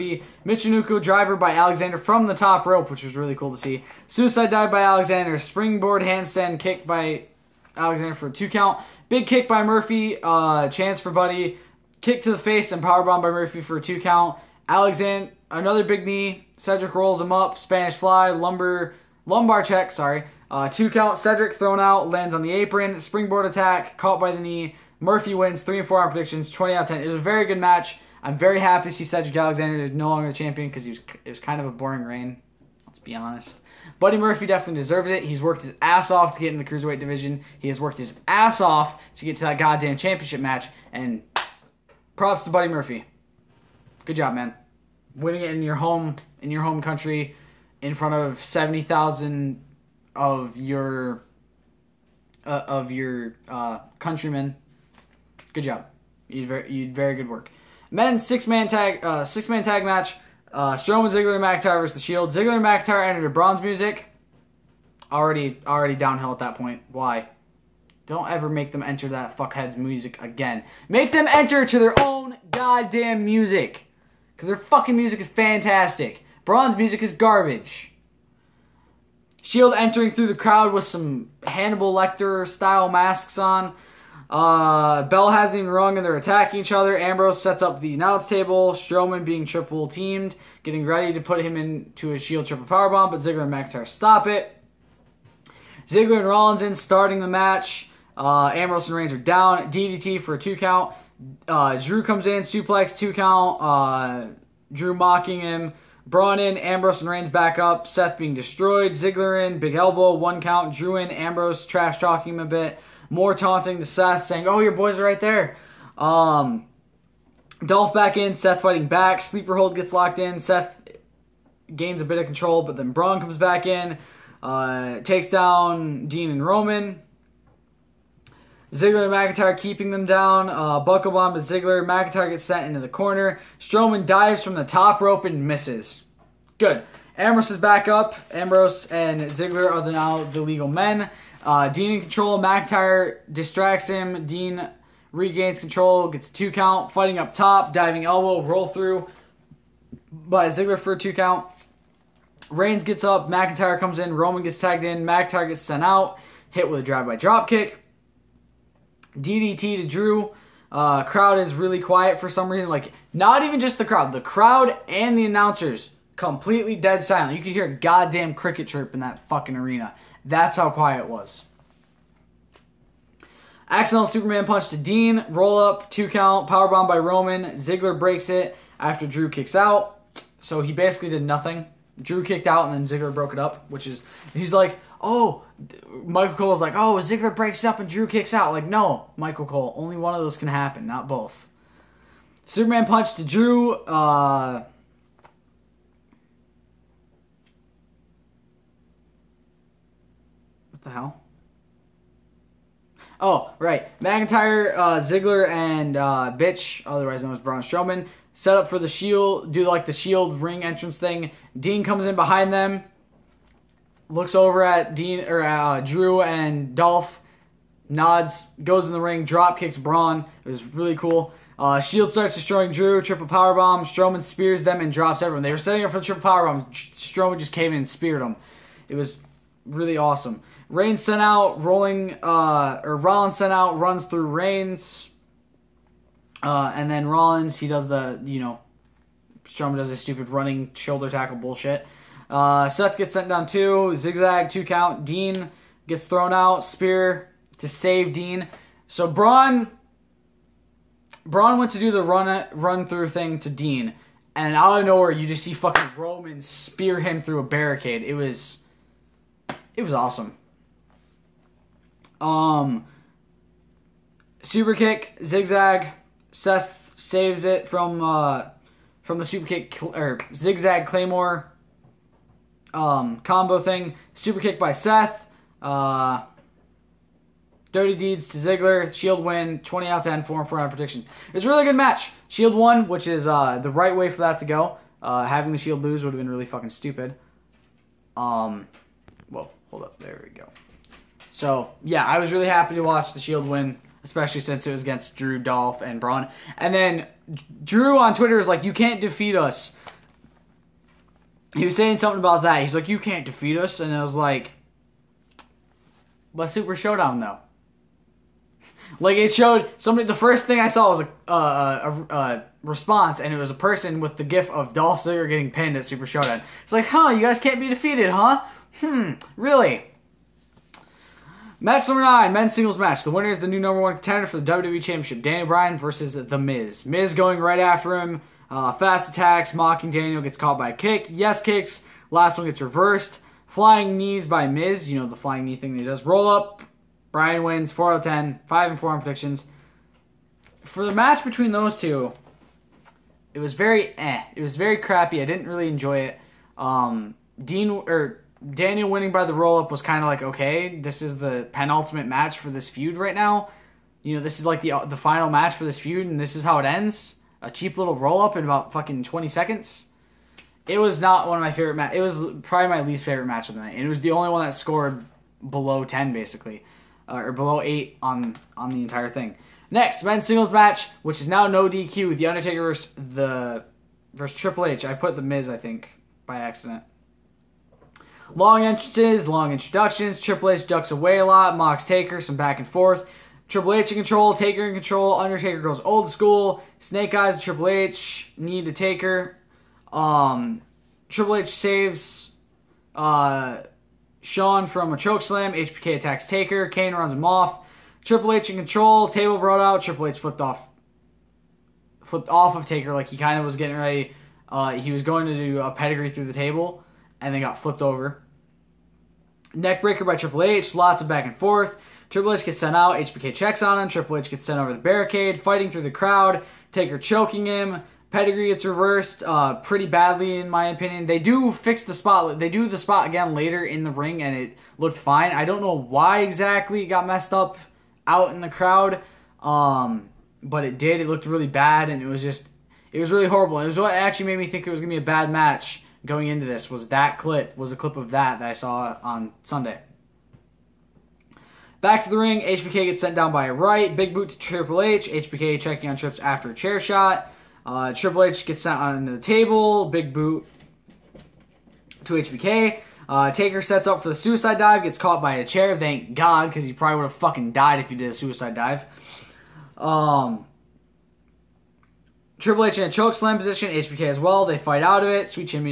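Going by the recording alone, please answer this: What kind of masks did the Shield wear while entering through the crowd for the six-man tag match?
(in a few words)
Hannibal Lecter style.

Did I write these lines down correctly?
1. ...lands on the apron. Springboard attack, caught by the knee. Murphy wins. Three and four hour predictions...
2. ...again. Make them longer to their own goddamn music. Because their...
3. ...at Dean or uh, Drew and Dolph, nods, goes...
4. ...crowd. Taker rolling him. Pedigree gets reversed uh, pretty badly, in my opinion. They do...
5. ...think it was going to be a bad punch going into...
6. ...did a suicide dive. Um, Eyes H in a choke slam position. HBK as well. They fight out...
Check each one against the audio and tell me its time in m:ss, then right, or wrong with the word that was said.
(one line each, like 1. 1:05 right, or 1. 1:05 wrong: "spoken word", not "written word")
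1. 0:22 right
2. 1:10 wrong: "enter", not "longer"
3. 3:34 right
4. 6:55 wrong: "choking", not "rolling"
5. 7:14 wrong: "match", not "punch"
6. 7:37 wrong: "Triple", not "Eyes".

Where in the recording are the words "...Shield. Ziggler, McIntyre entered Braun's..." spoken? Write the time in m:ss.
1:01.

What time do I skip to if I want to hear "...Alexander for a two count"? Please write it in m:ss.
0:07.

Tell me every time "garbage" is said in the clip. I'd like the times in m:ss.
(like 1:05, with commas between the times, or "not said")
1:17.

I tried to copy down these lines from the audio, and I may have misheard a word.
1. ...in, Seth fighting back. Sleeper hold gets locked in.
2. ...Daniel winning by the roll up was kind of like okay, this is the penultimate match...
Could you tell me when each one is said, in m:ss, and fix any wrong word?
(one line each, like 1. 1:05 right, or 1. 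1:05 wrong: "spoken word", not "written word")
1. 1:58 right
2. 5:48 right.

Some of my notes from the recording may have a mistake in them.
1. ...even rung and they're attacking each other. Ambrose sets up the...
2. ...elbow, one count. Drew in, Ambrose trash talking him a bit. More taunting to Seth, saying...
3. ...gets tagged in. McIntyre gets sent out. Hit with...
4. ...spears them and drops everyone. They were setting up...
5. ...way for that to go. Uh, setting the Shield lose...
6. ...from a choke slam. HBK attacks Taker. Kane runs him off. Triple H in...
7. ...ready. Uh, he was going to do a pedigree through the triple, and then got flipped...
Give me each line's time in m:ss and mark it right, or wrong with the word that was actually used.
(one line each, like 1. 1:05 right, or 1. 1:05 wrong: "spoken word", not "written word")
1. 1:25 right
2. 1:49 right
3. 2:34 right
4. 3:44 right
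5. 4:43 wrong: "having", not "setting"
6. 6:34 right
7. 6:43 wrong: "table", not "triple".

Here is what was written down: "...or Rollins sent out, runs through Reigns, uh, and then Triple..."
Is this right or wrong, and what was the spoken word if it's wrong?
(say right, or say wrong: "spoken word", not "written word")
wrong: "Rollins", not "Triple".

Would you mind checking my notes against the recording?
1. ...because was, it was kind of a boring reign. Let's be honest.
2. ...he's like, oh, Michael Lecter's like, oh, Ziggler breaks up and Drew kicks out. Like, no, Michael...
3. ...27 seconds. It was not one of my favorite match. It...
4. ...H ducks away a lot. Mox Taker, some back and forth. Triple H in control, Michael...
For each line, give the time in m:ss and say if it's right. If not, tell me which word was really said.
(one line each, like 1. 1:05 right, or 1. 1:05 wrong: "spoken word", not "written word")
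1. 0:30 right
2. 3:04 wrong: "Cole", not "Lecter"
3. 5:59 wrong: "20", not "27"
4. 6:20 wrong: "Taker", not "Michael".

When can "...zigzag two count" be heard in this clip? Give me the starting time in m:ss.
4:03.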